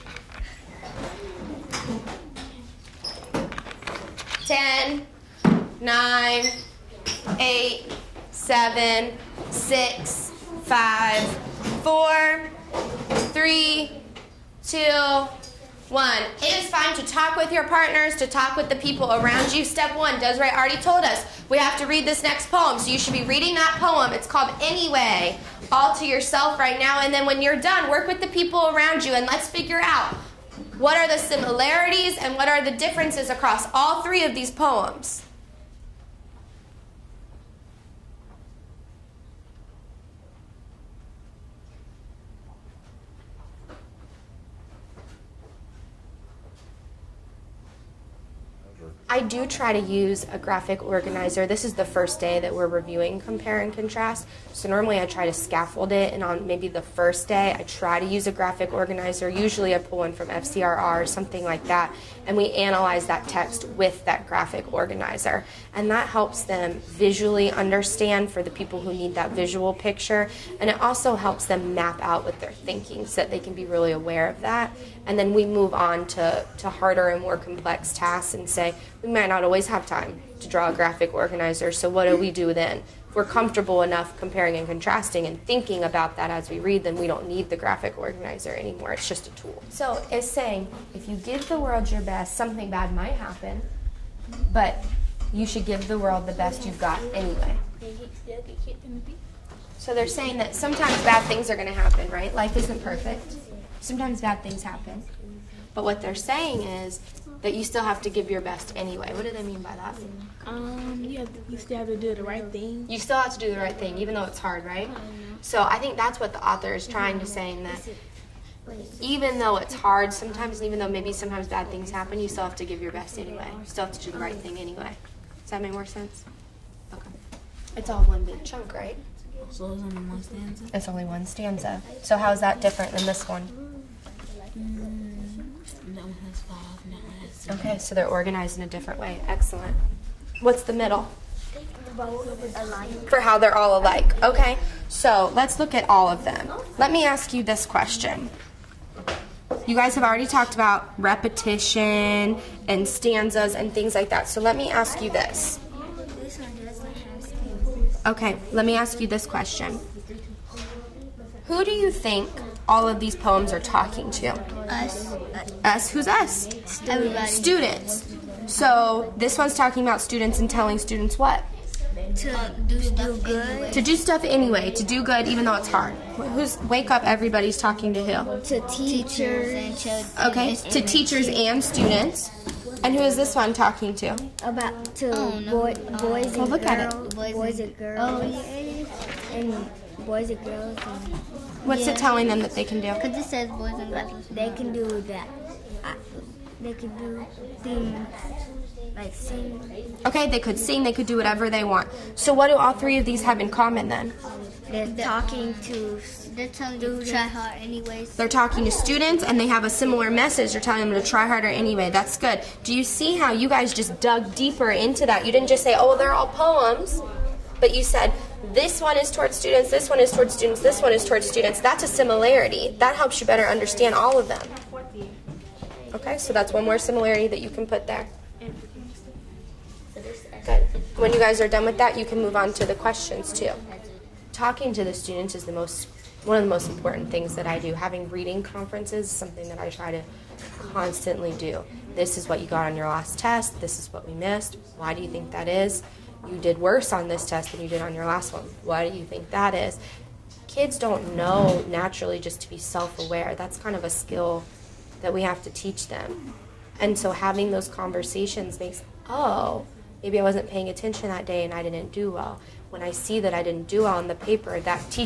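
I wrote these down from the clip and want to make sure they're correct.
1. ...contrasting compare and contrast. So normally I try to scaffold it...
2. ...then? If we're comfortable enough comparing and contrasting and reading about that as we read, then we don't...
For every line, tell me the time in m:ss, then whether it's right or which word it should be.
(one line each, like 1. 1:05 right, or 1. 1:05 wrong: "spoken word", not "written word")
1. 0:52 wrong: "reviewing", not "contrasting"
2. 1:22 wrong: "thinking", not "reading".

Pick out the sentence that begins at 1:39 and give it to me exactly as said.
So they're saying that sometimes bad things are going to happen, right?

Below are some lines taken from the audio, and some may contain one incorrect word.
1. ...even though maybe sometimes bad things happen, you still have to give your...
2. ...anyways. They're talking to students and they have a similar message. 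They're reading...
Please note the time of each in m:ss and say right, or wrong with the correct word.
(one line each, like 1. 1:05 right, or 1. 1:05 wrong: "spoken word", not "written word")
1. 2:00 right
2. 3:27 wrong: "telling", not "reading".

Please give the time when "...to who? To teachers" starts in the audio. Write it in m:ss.
2:57.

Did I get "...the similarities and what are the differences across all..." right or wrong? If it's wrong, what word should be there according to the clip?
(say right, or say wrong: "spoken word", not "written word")
right.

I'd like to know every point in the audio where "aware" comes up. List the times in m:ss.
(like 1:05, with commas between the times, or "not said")
1:13, 4:12.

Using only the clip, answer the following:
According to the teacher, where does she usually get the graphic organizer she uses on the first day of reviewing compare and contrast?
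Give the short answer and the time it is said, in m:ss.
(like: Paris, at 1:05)
FCRR, at 1:00.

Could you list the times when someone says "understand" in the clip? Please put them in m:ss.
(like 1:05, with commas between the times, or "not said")
1:07, 3:43.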